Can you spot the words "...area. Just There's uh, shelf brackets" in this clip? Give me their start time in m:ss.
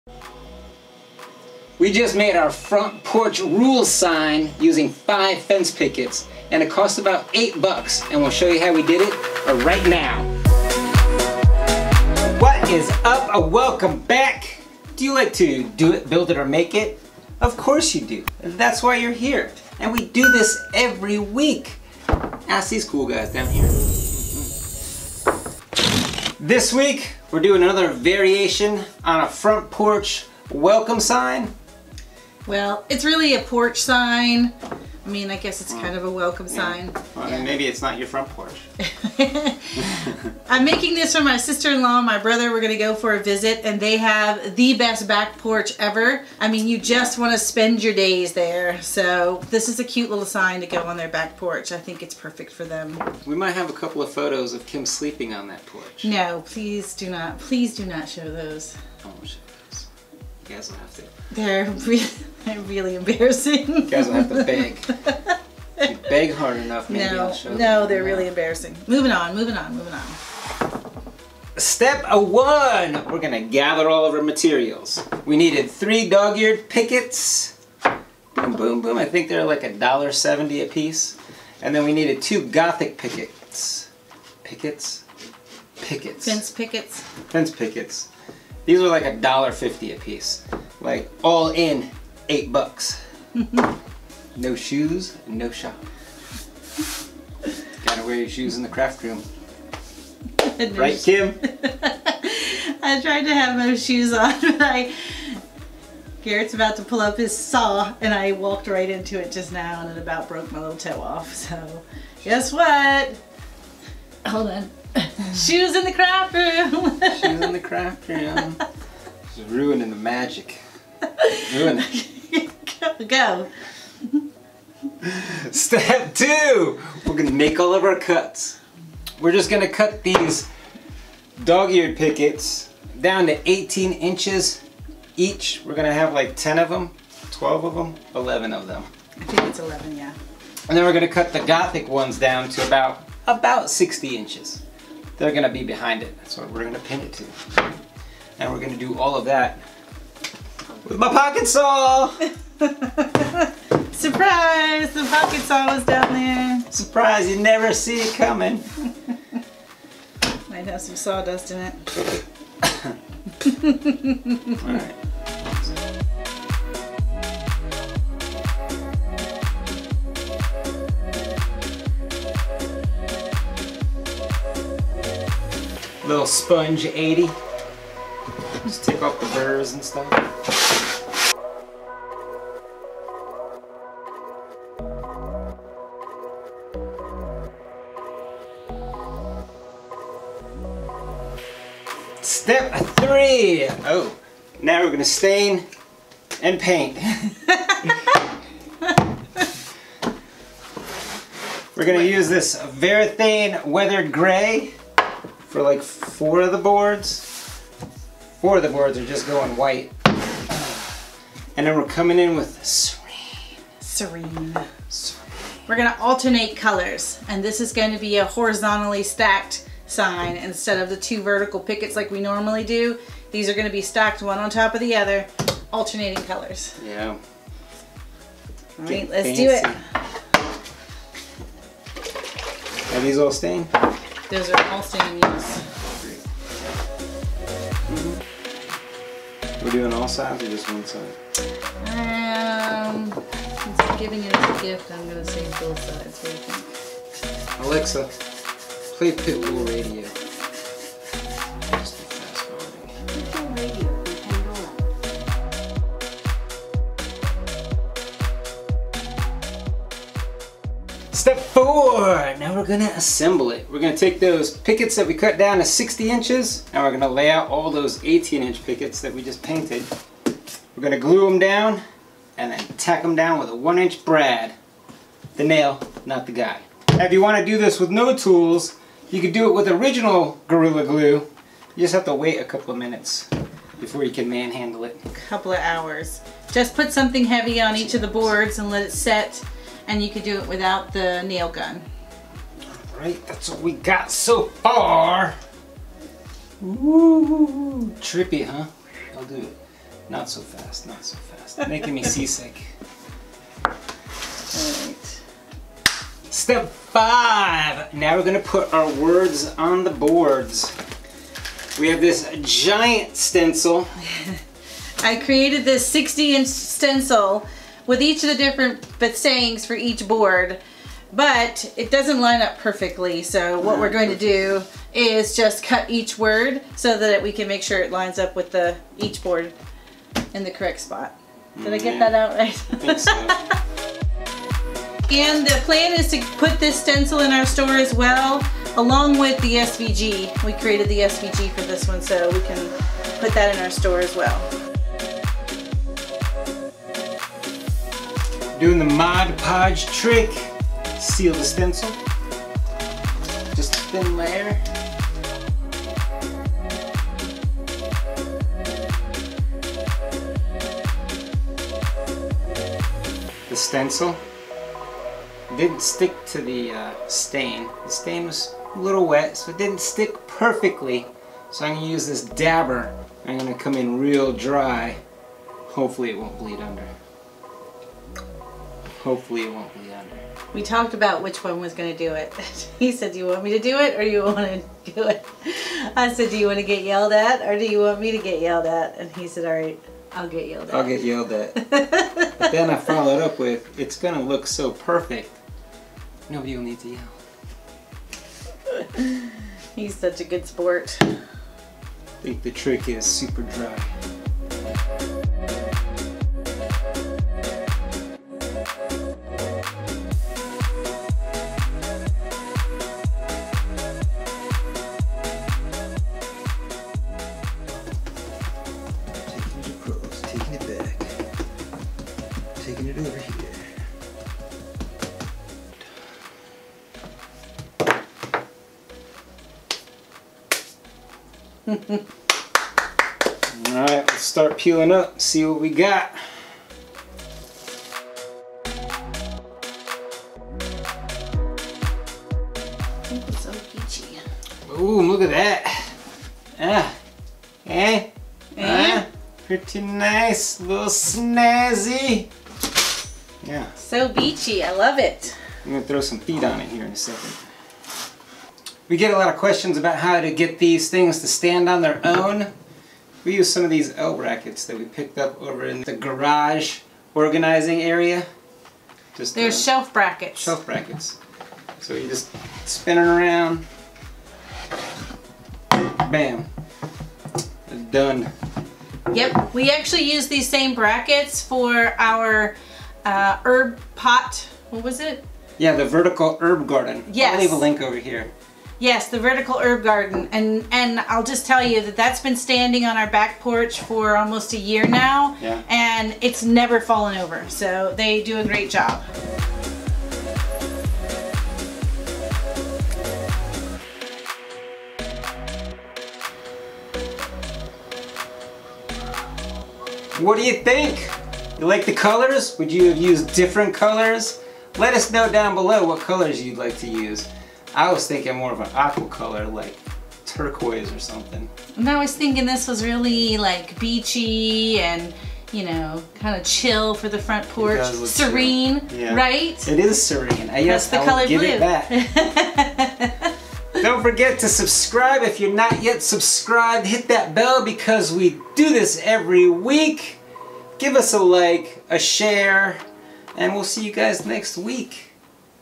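7:47.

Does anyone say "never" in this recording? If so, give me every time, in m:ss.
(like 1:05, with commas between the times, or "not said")
2:37, 8:16.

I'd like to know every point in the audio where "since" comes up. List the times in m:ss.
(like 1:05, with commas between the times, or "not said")
4:03.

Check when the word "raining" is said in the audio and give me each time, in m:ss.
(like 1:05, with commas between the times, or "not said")
not said.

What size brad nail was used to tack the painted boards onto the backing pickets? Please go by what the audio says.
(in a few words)
1 inch.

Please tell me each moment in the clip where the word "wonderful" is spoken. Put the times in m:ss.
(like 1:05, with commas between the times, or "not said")
not said.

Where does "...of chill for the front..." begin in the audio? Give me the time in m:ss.
8:46.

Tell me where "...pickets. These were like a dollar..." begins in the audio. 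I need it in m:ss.
1:27.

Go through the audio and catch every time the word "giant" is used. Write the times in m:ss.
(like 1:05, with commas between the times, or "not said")
5:12.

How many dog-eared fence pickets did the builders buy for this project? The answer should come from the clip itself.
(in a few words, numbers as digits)
3.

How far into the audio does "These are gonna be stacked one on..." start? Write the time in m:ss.
3:43.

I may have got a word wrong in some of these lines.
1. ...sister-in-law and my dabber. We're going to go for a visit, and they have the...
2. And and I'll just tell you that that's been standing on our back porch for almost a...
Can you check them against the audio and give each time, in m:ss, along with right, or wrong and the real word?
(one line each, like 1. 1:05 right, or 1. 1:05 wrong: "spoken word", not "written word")
1. 0:41 wrong: "brother", not "dabber"
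2. 8:10 right.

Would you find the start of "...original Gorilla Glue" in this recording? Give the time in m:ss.
4:39.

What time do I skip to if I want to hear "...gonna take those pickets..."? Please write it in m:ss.
4:23.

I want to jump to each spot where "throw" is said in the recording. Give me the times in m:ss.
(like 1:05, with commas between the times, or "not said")
7:35.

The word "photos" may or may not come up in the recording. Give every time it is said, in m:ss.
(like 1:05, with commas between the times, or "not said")
0:54.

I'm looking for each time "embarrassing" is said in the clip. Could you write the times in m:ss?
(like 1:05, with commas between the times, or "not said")
1:02, 1:08.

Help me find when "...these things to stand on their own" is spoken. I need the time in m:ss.
7:40.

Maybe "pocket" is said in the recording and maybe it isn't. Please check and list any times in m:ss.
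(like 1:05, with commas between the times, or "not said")
2:31, 2:35.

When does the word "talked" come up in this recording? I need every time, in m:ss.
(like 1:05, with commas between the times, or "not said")
6:20.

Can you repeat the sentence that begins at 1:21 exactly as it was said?
And then we needed two gothic pickets.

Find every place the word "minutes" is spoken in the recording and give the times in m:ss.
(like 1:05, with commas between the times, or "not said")
4:42.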